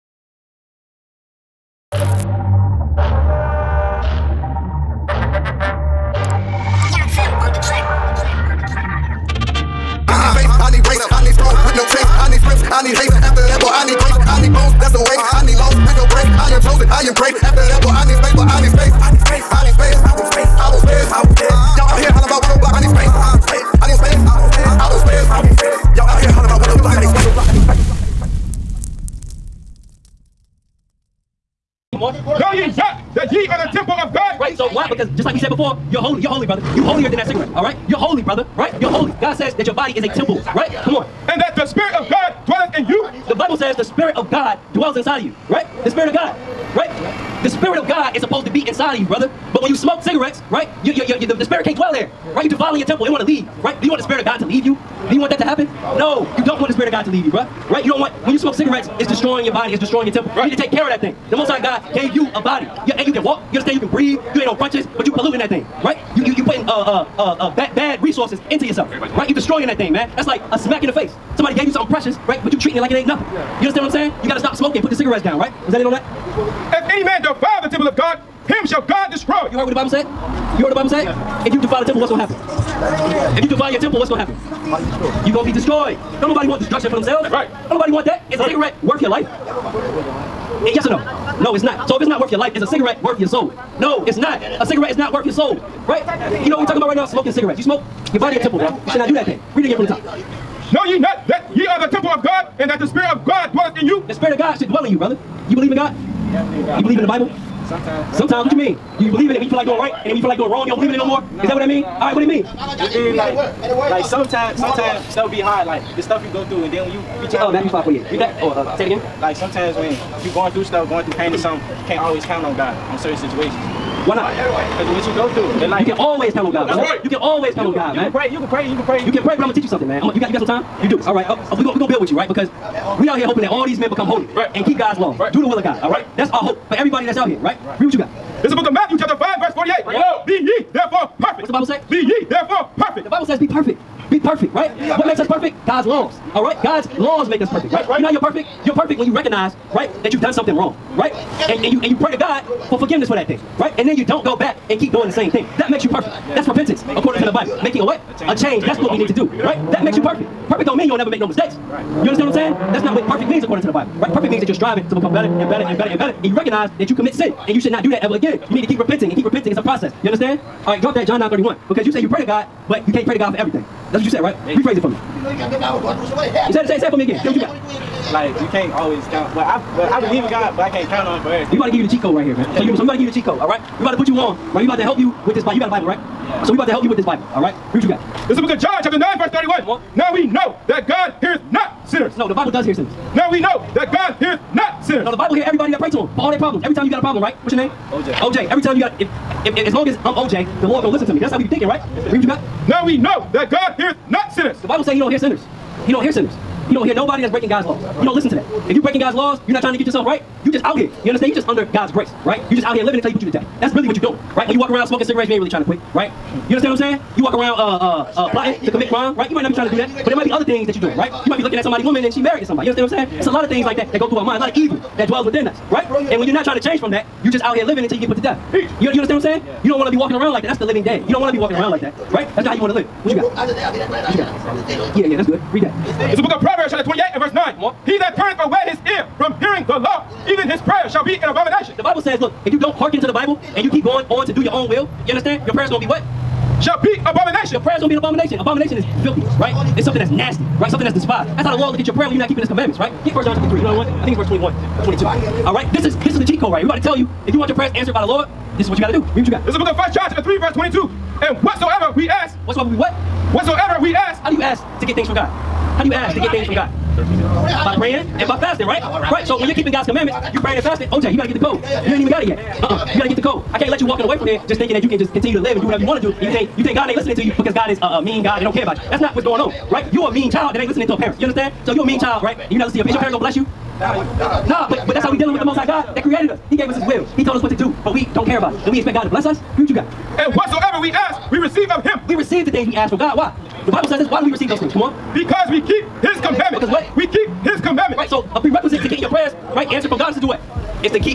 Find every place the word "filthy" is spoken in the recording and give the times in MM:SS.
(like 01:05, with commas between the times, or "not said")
04:09.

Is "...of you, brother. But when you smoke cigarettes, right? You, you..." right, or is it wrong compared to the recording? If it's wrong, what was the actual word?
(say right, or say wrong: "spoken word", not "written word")
right.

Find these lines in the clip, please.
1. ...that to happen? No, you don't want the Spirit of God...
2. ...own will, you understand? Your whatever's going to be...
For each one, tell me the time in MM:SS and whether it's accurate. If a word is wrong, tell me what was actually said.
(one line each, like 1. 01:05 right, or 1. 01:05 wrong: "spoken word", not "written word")
1. 00:55 right
2. 04:04 wrong: "prayer", not "whatever".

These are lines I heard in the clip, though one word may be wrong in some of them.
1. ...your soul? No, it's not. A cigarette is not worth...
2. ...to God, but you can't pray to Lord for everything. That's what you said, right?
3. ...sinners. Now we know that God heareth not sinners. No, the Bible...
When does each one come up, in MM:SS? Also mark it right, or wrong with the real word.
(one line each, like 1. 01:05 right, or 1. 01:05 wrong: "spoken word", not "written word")
1. 01:33 right
2. 02:52 wrong: "God", not "Lord"
3. 03:12 right.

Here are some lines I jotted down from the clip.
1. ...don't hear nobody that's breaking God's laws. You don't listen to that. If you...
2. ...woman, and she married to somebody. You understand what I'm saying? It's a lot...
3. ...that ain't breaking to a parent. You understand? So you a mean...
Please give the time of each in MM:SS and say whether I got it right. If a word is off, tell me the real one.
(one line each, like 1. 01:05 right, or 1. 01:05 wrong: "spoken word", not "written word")
1. 03:26 right
2. 03:41 right
3. 04:40 wrong: "listening", not "breaking".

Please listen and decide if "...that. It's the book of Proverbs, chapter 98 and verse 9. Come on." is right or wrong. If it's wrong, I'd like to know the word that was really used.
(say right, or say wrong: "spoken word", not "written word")
wrong: "28", not "98".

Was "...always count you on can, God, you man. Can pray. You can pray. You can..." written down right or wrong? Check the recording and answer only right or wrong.
right.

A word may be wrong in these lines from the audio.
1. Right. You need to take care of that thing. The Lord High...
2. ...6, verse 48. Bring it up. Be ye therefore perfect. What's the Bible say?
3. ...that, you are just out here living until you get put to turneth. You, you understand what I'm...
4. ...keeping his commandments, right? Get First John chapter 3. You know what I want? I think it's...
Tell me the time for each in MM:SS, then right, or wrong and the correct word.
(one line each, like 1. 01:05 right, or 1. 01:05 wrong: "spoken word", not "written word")
1. 01:00 wrong: "Most", not "Lord"
2. 02:19 wrong: "5", not "6"
3. 03:46 wrong: "death", not "turneth"
4. 04:12 right.